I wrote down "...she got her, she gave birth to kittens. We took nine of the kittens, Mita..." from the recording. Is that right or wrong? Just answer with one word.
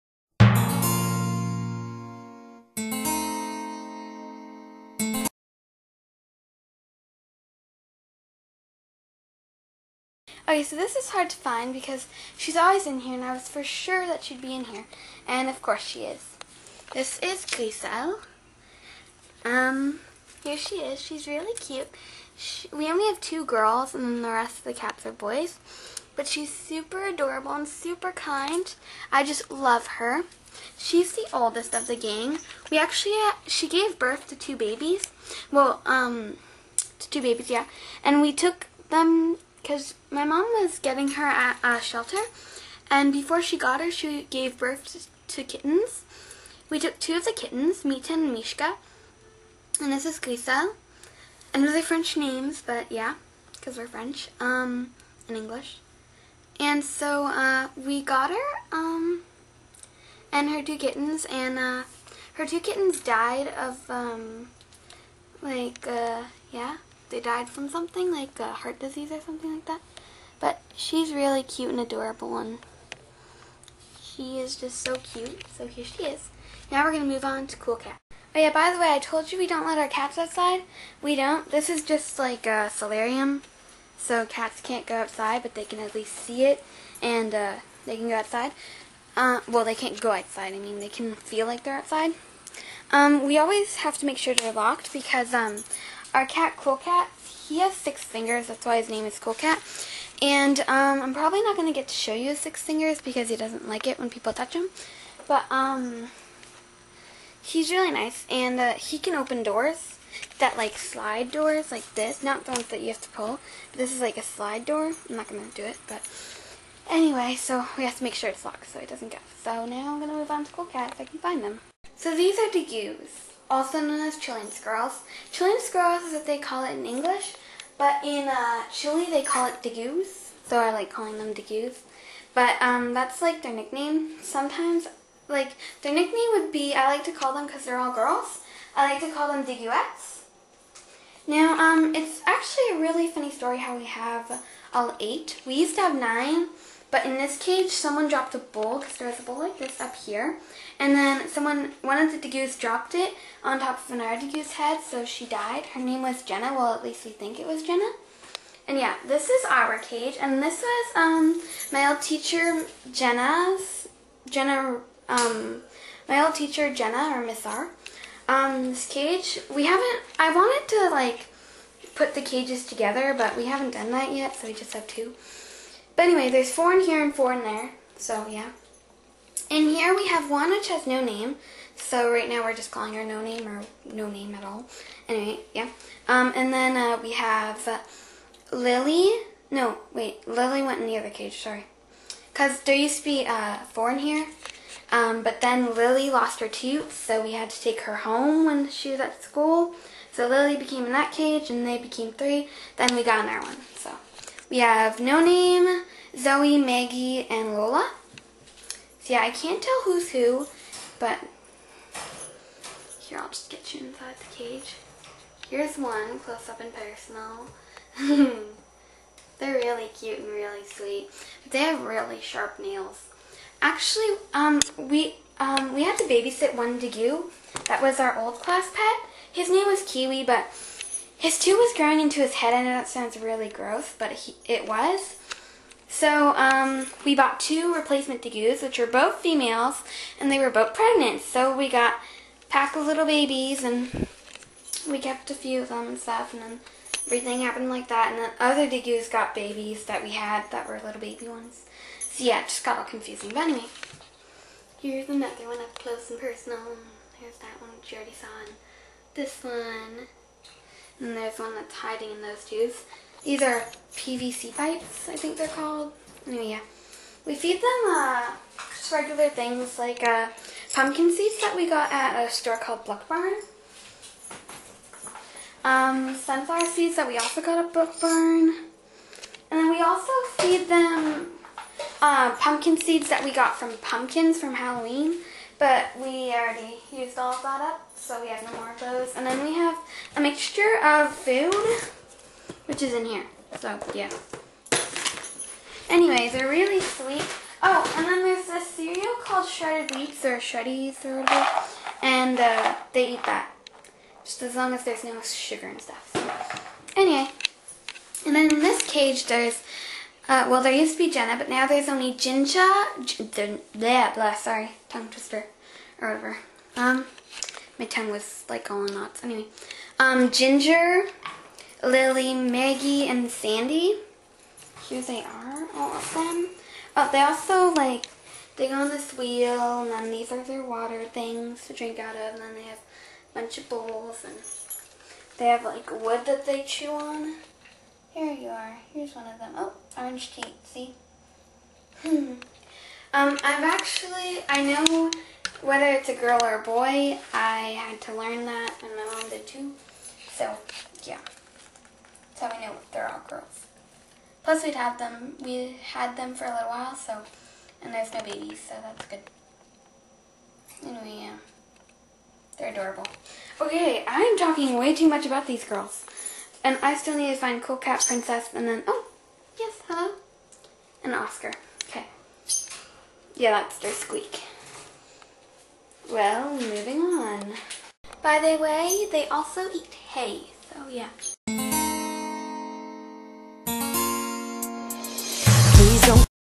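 wrong.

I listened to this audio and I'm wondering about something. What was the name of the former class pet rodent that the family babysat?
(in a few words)
Kiwi.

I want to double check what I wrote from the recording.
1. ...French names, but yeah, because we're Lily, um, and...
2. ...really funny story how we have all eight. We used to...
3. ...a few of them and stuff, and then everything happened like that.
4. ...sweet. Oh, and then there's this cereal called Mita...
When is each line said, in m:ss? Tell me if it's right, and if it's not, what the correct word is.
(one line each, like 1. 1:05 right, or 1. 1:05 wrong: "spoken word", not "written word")
1. 0:51 wrong: "French", not "Lily"
2. 2:22 right
3. 4:05 right
4. 4:56 wrong: "Shredded", not "Mita".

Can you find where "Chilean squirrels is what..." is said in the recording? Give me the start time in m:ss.
2:05.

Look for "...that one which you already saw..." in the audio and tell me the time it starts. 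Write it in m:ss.
4:17.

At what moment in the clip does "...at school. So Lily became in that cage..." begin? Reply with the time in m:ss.
3:19.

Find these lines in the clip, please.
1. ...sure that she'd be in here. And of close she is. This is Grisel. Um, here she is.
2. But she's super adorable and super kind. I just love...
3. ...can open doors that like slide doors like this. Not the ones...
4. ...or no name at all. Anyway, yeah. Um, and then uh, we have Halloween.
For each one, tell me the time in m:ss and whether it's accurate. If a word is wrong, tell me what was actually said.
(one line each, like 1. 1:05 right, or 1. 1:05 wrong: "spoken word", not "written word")
1. 0:13 wrong: "course", not "close"
2. 0:26 right
3. 1:48 right
4. 3:03 wrong: "Lily", not "Halloween".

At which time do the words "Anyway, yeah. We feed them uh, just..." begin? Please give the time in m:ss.
4:26.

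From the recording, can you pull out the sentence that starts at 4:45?
But we already used all of that up, so we have no more of those.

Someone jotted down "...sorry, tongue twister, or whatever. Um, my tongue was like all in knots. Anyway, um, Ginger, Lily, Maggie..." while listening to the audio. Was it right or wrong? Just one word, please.
right.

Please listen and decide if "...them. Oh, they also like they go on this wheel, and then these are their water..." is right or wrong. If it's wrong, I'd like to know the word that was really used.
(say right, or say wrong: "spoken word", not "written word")
right.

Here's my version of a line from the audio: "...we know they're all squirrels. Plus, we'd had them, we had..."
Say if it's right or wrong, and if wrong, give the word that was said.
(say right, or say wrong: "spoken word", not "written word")
wrong: "girls", not "squirrels".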